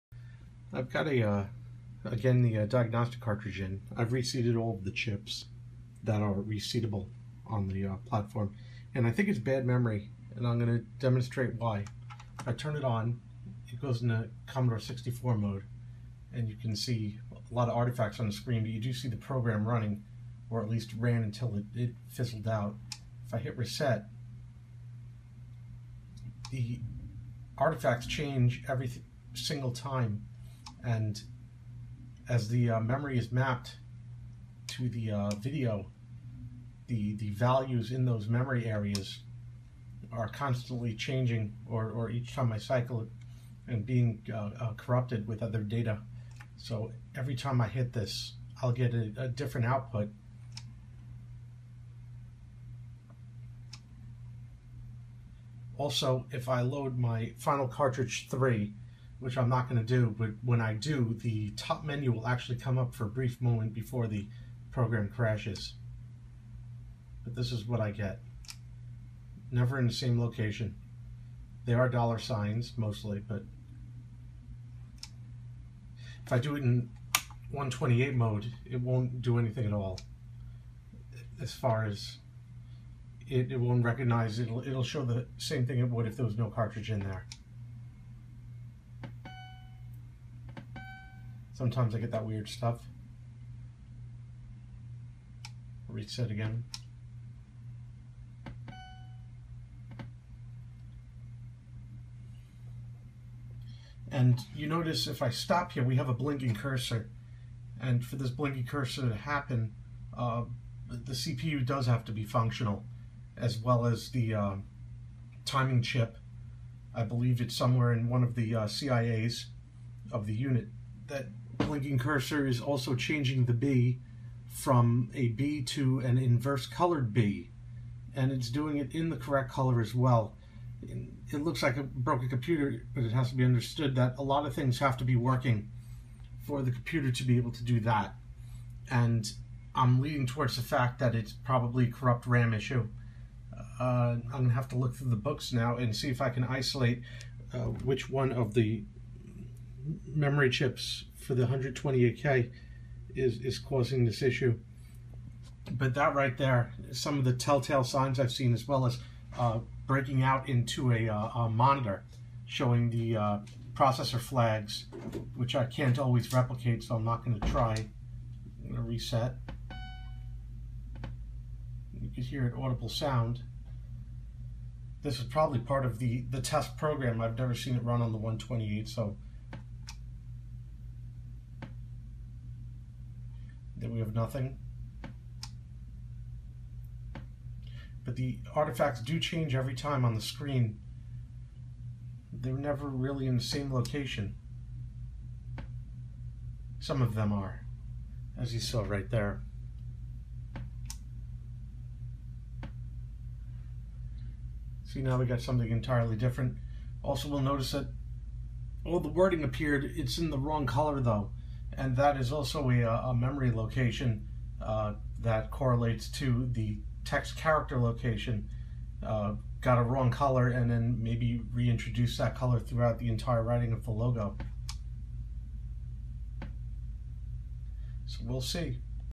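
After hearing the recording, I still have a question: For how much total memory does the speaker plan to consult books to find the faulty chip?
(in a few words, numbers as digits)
128K.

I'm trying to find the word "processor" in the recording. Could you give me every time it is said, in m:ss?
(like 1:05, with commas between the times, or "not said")
2:43.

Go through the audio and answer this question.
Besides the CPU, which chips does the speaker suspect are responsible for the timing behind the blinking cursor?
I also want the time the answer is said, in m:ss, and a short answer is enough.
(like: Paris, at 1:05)
CIAs, at 1:58.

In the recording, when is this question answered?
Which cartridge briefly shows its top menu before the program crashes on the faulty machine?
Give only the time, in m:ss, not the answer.
0:57.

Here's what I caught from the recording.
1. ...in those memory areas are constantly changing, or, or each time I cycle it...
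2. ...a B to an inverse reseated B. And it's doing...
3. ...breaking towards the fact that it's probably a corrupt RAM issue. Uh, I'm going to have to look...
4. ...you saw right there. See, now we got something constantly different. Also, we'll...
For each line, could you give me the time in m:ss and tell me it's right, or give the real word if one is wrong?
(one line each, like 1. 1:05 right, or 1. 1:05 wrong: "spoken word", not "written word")
1. 0:37 right
2. 2:05 wrong: "colored", not "reseated"
3. 2:20 wrong: "leaning", not "breaking"
4. 3:18 wrong: "entirely", not "constantly".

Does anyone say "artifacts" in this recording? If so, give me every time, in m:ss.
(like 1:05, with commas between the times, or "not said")
0:17, 0:27, 3:08.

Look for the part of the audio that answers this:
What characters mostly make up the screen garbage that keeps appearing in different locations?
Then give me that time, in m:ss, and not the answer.
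1:11.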